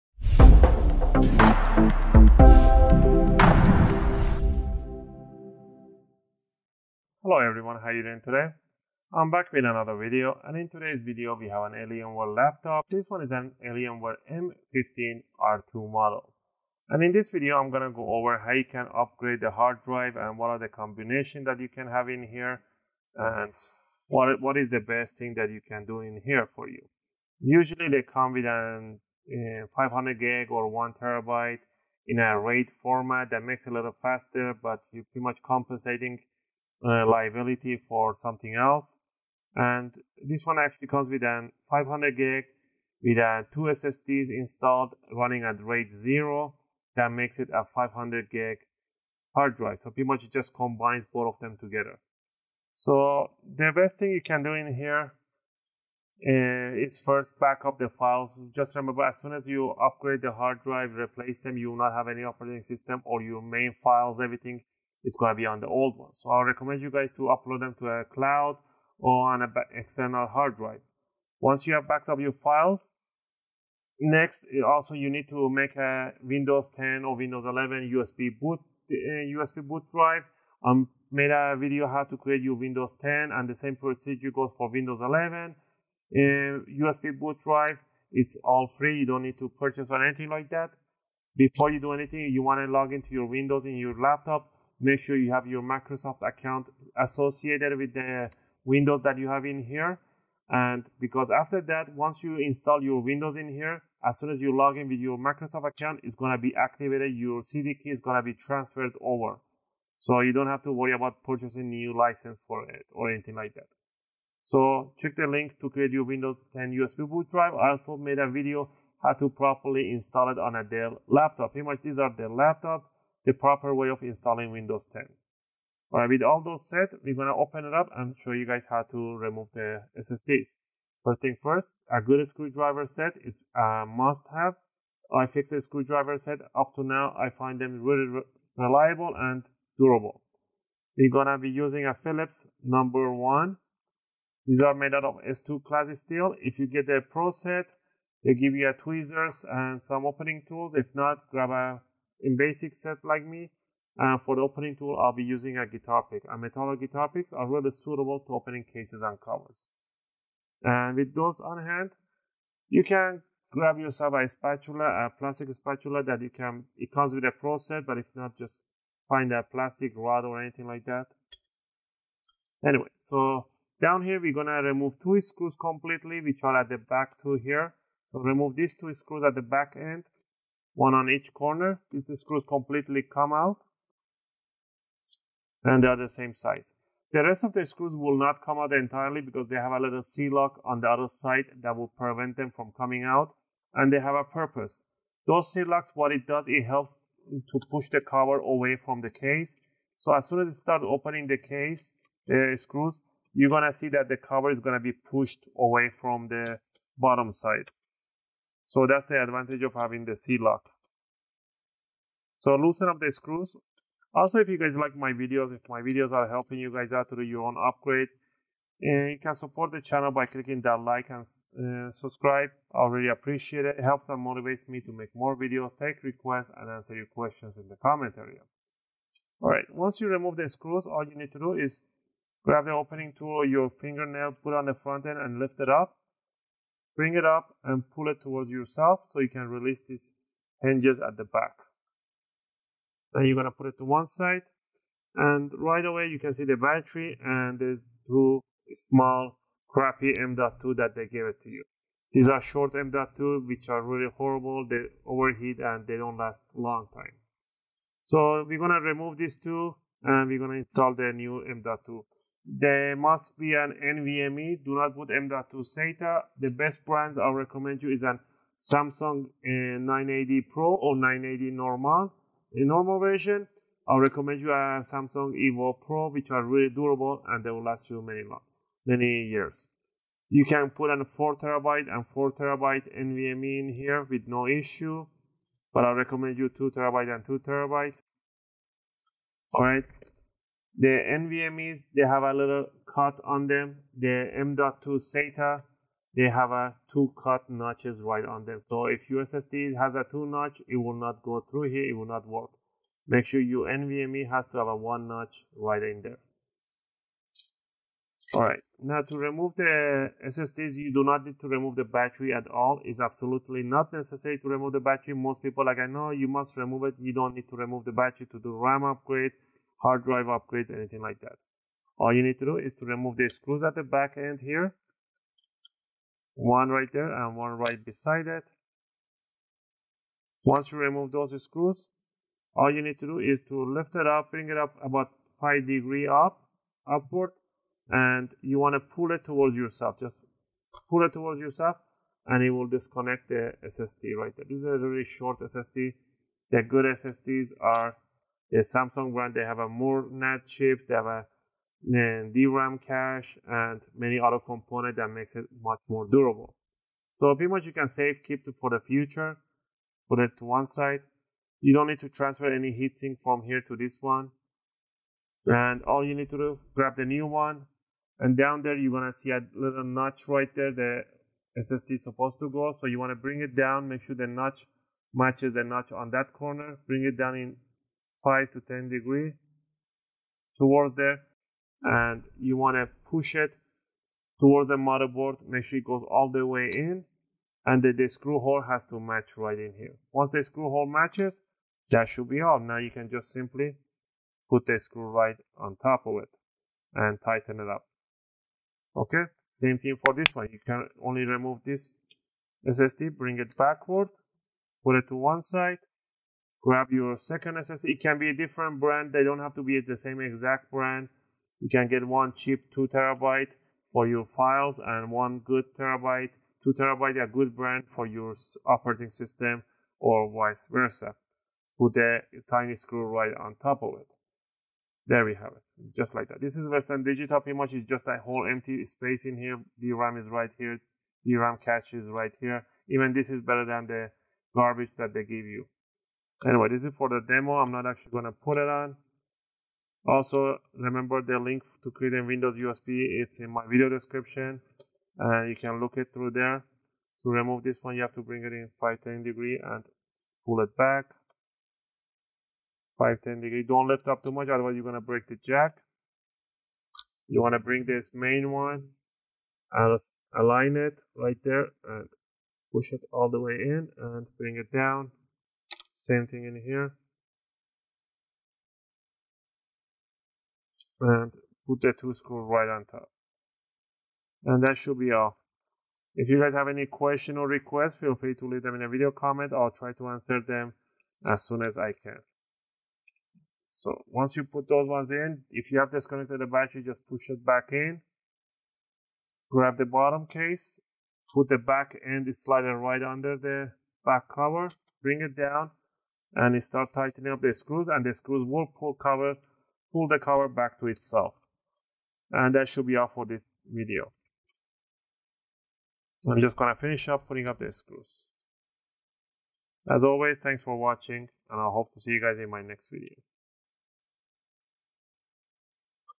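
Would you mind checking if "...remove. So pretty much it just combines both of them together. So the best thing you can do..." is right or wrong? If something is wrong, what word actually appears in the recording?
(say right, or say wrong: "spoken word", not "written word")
wrong: "drive", not "remove".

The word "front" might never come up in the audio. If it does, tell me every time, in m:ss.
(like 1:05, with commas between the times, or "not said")
3:54.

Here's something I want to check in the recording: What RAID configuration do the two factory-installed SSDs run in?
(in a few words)
RAID zero.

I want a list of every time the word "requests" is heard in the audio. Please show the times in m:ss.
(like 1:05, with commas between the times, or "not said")
3:46, 7:57.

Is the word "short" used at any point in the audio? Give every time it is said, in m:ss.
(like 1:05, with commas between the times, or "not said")
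4:12, 5:45.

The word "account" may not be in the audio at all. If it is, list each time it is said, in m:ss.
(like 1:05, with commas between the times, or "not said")
1:36, 1:45.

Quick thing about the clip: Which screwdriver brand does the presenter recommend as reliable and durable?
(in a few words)
iFixit.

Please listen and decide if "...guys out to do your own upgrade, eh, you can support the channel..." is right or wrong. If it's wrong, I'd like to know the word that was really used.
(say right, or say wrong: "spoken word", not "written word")
right.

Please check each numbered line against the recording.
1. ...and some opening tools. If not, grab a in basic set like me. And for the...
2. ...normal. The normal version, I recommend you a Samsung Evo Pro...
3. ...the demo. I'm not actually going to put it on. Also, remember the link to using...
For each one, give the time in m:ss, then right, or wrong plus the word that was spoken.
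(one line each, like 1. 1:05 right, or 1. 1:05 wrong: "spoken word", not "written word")
1. 2:29 right
2. 4:31 right
3. 7:17 wrong: "creating", not "using".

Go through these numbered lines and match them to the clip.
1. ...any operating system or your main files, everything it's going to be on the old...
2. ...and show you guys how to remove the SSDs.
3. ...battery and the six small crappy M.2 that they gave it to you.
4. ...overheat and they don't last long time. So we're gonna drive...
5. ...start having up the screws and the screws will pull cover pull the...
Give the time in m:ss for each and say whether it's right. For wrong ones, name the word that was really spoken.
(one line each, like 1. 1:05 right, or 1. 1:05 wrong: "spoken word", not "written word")
1. 1:02 right
2. 2:07 right
3. 4:06 wrong: "two", not "six"
4. 4:15 wrong: "remove", not "drive"
5. 8:16 wrong: "tightening", not "having".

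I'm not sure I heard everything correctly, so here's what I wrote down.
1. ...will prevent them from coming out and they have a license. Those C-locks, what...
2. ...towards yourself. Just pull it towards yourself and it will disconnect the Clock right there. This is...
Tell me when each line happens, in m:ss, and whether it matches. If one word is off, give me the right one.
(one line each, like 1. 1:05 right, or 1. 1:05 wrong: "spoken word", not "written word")
1. 3:11 wrong: "purpose", not "license"
2. 5:39 wrong: "SSD", not "Clock".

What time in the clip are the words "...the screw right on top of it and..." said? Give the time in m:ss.
6:34.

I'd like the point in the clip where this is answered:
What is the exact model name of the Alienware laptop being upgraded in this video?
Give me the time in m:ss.
0:14.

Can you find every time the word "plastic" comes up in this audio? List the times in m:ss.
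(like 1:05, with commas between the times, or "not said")
2:45, 2:49.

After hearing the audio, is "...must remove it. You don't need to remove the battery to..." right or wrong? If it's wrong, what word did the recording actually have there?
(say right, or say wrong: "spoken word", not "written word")
right.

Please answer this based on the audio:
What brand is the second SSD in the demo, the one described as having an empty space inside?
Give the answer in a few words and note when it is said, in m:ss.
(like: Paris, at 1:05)
Western Digital, at 7:06.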